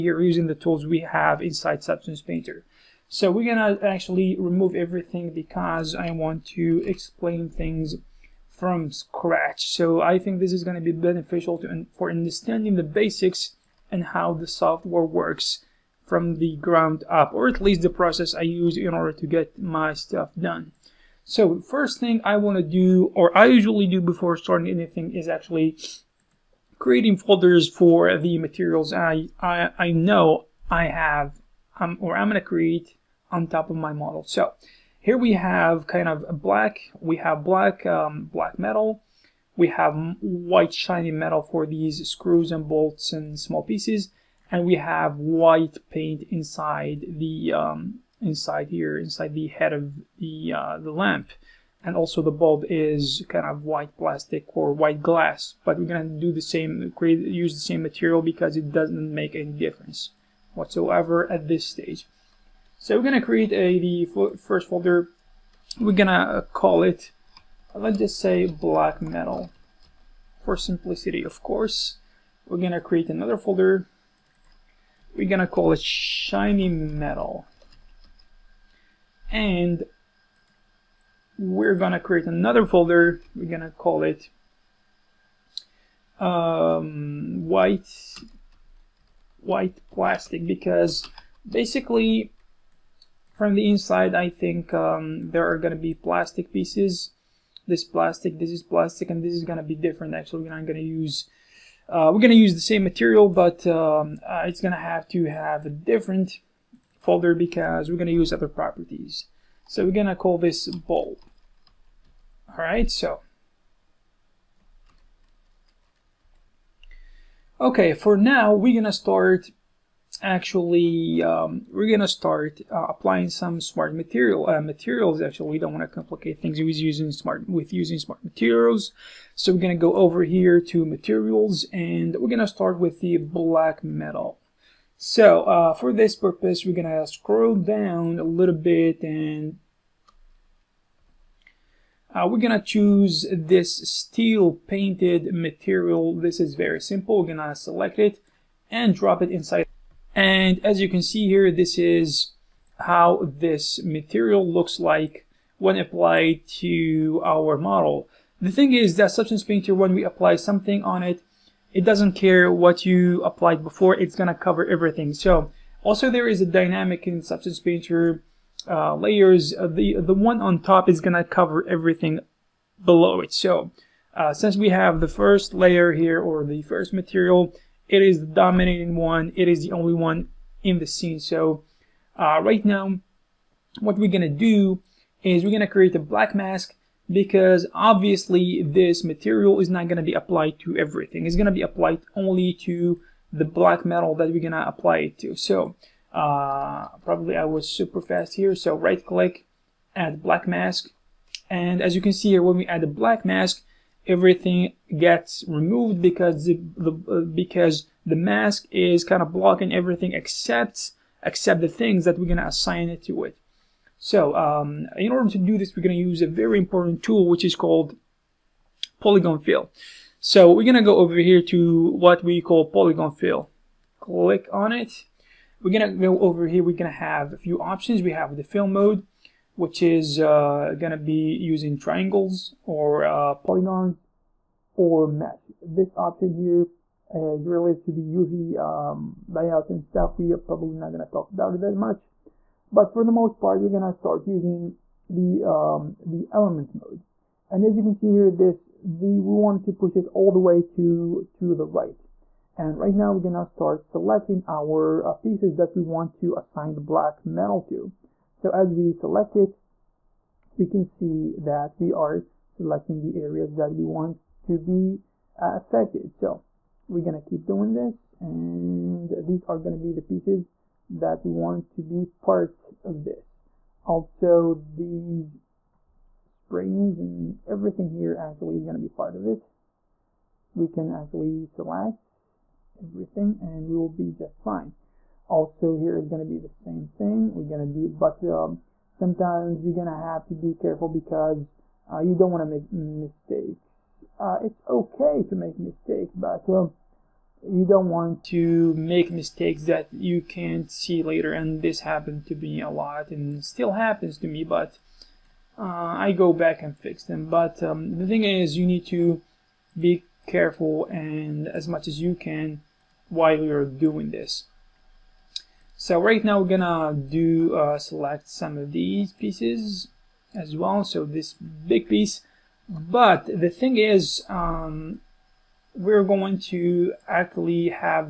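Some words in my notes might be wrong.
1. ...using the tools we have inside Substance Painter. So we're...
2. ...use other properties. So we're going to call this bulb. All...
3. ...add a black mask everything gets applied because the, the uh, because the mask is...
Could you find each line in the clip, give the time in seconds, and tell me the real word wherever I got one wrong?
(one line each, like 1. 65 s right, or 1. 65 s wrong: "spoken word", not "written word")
1. 0 s right
2. 108 s right
3. 202 s wrong: "removed", not "applied".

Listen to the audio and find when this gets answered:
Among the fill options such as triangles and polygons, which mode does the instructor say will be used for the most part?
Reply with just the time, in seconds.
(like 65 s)
246 s.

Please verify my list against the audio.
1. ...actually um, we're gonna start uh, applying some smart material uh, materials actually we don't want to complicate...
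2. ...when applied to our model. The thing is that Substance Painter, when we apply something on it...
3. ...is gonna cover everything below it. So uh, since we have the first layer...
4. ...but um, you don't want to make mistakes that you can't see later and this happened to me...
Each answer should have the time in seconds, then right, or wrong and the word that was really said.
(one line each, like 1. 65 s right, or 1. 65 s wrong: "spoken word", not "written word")
1. 120 s right
2. 155 s right
3. 170 s right
4. 296 s right.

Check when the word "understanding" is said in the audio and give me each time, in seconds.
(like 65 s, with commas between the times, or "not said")
12 s.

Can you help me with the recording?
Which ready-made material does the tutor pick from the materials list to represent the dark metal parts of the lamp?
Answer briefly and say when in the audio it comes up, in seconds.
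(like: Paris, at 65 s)
steel painted, at 143 s.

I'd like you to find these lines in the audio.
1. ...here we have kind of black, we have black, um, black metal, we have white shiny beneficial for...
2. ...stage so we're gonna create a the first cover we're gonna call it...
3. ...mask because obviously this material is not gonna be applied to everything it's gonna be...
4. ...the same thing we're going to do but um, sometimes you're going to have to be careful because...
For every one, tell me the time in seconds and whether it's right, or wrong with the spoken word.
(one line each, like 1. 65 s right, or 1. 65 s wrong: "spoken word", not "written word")
1. 34 s wrong: "metal", not "beneficial"
2. 61 s wrong: "folder", not "cover"
3. 186 s right
4. 286 s right.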